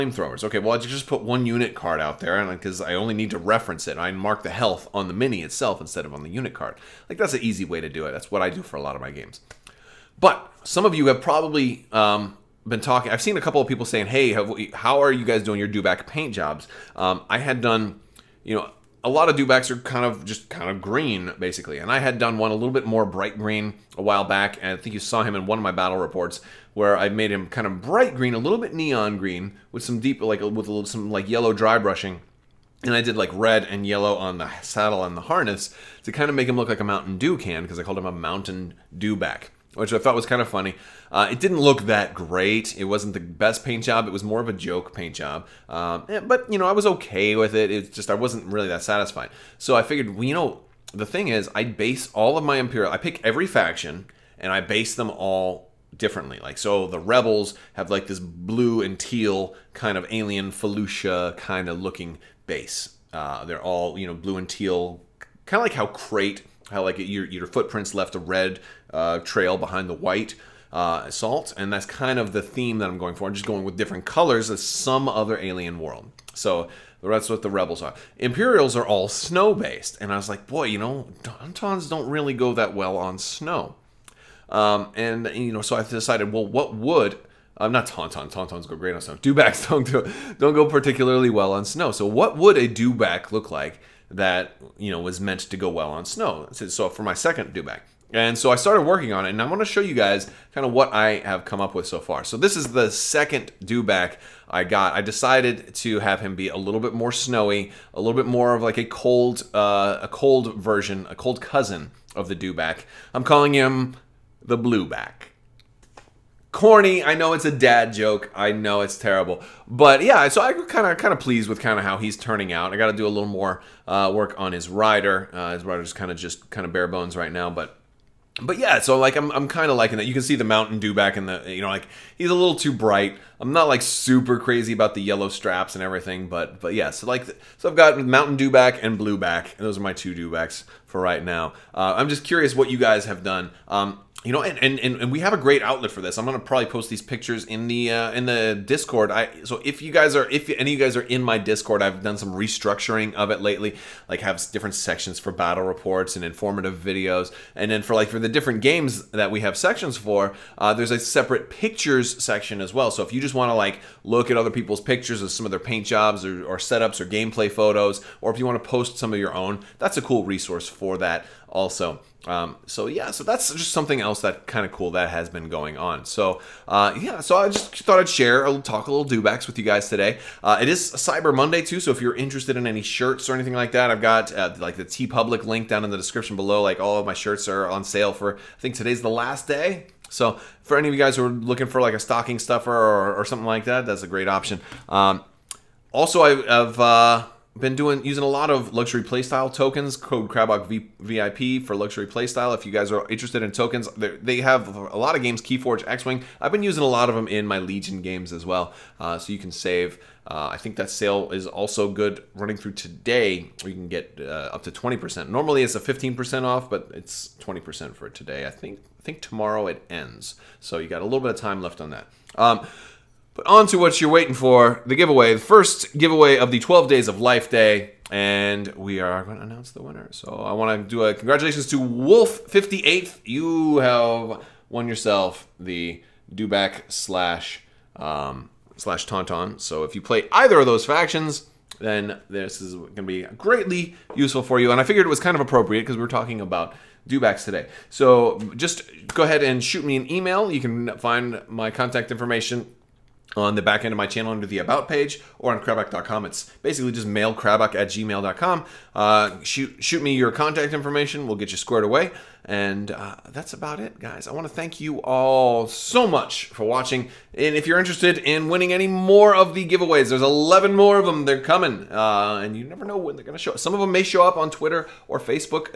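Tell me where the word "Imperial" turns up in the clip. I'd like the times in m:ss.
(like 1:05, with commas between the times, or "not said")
0:52, 1:18.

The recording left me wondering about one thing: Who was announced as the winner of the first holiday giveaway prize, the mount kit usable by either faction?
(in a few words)
Wolf58.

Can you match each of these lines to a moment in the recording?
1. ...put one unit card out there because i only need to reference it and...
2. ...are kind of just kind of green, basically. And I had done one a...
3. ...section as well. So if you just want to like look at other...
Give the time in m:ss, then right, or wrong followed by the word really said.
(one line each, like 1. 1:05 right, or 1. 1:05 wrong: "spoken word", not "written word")
1. 0:01 right
2. 0:19 right
3. 2:42 right.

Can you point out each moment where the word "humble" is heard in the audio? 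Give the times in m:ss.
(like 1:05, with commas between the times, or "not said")
not said.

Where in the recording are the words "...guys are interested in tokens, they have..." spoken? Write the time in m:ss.
3:22.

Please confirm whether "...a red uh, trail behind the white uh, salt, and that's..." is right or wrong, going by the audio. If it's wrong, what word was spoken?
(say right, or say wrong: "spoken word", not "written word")
right.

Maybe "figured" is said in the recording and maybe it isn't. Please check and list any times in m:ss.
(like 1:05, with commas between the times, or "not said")
0:49, 4:04.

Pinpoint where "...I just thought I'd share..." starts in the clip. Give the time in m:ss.
2:57.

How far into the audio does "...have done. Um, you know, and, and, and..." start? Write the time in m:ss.
2:23.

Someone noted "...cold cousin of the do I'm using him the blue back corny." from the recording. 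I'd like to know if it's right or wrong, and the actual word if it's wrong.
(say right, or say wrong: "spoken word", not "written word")
wrong: "calling", not "using".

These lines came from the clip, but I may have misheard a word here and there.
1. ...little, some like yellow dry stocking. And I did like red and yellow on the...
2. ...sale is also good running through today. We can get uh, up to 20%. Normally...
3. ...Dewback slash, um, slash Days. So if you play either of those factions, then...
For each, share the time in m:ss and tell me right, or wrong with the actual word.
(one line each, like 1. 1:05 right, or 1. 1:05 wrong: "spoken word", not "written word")
1. 0:30 wrong: "brushing", not "stocking"
2. 3:30 right
3. 3:56 wrong: "Tauntaun", not "Days".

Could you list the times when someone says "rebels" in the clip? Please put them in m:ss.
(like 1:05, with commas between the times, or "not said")
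0:56, 1:17.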